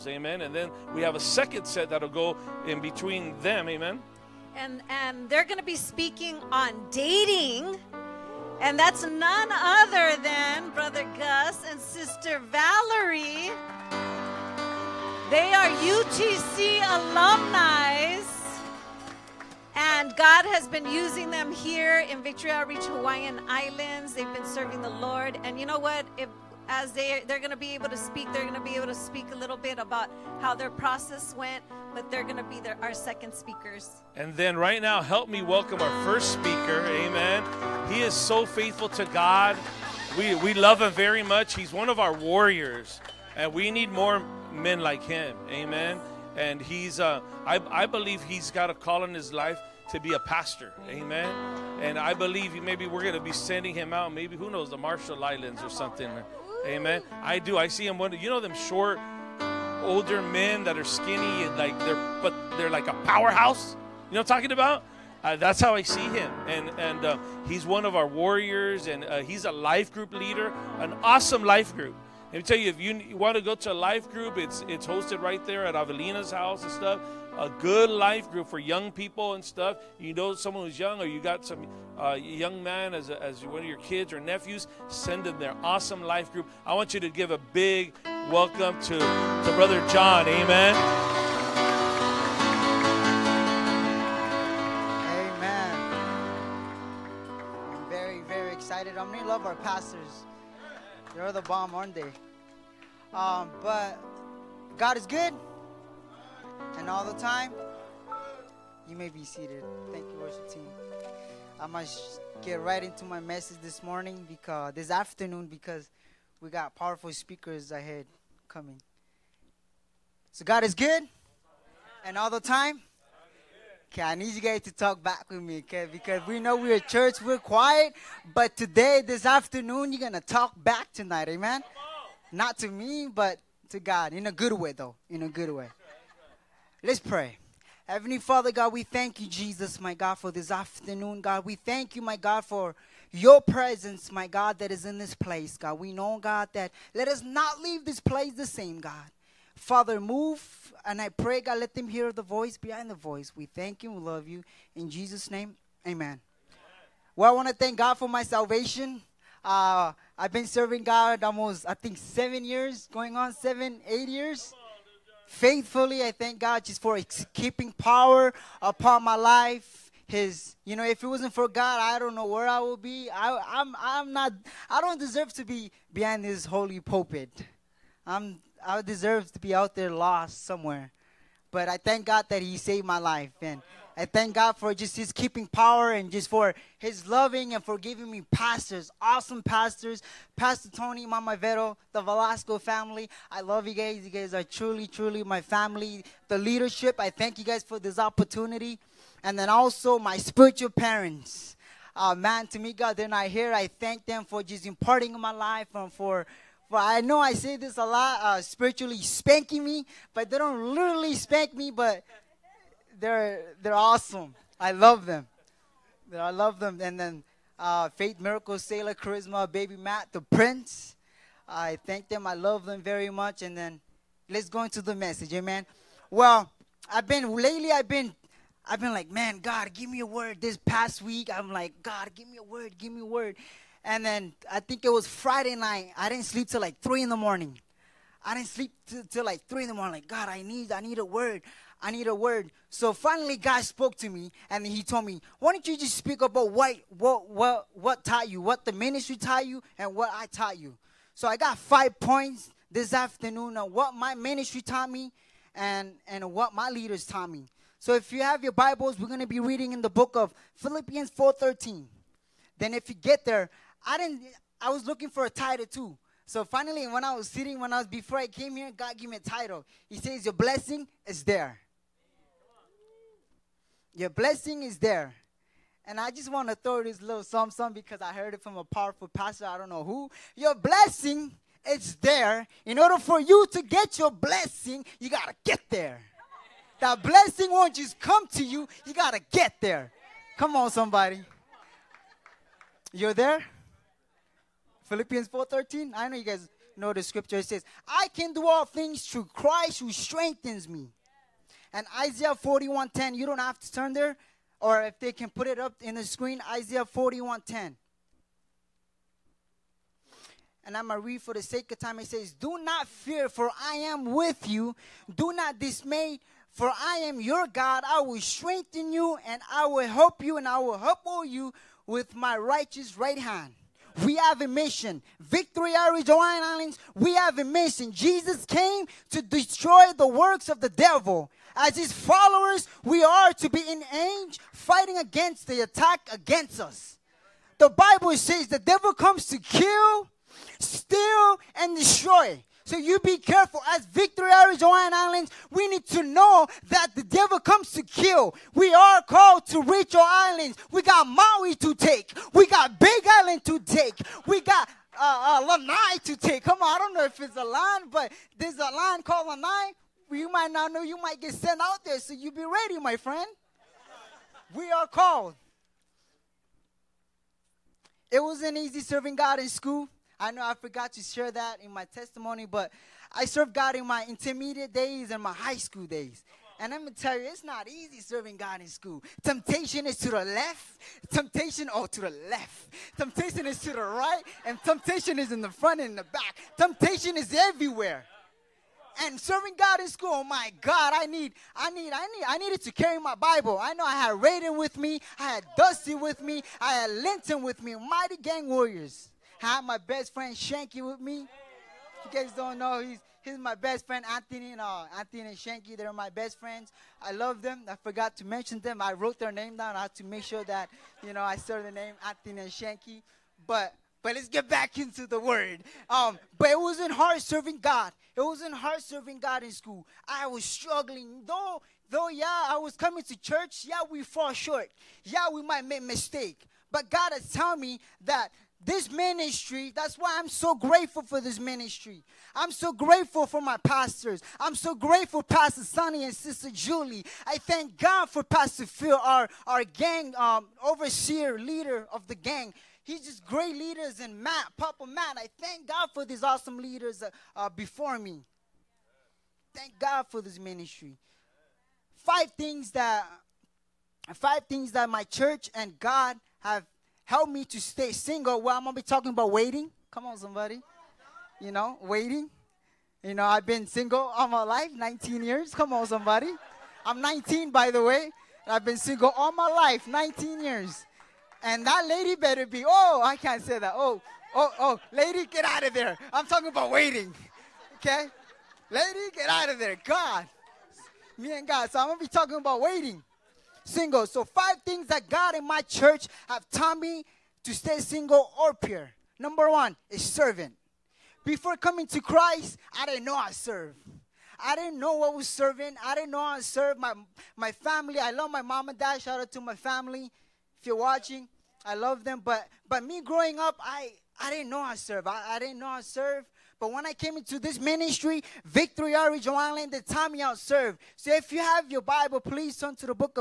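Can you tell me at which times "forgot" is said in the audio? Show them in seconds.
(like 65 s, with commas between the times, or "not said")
370 s, 407 s.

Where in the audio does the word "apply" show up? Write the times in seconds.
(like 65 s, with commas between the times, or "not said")
not said.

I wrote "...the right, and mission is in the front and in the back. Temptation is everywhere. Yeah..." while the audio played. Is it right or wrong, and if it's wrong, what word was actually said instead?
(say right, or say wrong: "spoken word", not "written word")
wrong: "temptation", not "mission".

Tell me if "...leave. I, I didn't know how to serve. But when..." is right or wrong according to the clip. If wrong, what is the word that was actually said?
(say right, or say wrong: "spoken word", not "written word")
wrong: "serve", not "leave".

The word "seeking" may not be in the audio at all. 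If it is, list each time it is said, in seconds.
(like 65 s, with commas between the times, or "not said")
not said.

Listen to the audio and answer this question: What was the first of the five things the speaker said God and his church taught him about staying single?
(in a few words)
Servant.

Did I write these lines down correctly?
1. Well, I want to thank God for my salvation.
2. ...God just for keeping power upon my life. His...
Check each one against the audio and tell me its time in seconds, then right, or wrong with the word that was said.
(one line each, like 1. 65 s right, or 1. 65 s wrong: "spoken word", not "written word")
1. 157 s right
2. 166 s right.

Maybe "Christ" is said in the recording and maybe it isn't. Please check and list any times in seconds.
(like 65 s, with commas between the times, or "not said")
299 s, 491 s.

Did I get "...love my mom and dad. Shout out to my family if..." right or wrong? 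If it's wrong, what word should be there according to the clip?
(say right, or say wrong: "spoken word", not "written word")
right.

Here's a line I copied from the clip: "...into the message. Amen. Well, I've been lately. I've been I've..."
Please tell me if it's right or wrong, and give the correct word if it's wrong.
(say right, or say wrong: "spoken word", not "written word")
right.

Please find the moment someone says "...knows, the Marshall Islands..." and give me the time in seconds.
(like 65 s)
54 s.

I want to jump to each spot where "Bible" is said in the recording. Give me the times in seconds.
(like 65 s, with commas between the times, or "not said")
258 s, 337 s, 393 s, 511 s.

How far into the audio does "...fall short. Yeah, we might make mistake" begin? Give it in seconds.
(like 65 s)
424 s.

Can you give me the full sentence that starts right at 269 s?
He says, your blessing is there.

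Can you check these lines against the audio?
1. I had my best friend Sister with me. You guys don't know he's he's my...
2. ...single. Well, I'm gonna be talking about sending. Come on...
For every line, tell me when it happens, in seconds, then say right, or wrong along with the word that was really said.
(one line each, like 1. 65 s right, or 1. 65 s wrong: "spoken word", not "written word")
1. 399 s wrong: "Shanky", not "Sister"
2. 457 s wrong: "waiting", not "sending".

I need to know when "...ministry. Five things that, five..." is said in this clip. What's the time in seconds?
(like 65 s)
450 s.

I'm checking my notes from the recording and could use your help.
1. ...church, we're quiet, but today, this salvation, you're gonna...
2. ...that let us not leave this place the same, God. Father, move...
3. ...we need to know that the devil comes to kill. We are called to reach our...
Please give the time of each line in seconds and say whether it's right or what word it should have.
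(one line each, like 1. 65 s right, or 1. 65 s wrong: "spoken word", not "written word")
1. 126 s wrong: "afternoon", not "salvation"
2. 146 s right
3. 345 s right.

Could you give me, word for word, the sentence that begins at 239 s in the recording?
Like, God, I need, I need a word.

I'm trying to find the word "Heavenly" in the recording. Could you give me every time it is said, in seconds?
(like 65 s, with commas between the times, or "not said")
137 s.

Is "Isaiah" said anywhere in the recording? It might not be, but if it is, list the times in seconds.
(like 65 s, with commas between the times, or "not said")
301 s, 306 s.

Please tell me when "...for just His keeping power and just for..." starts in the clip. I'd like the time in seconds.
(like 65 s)
184 s.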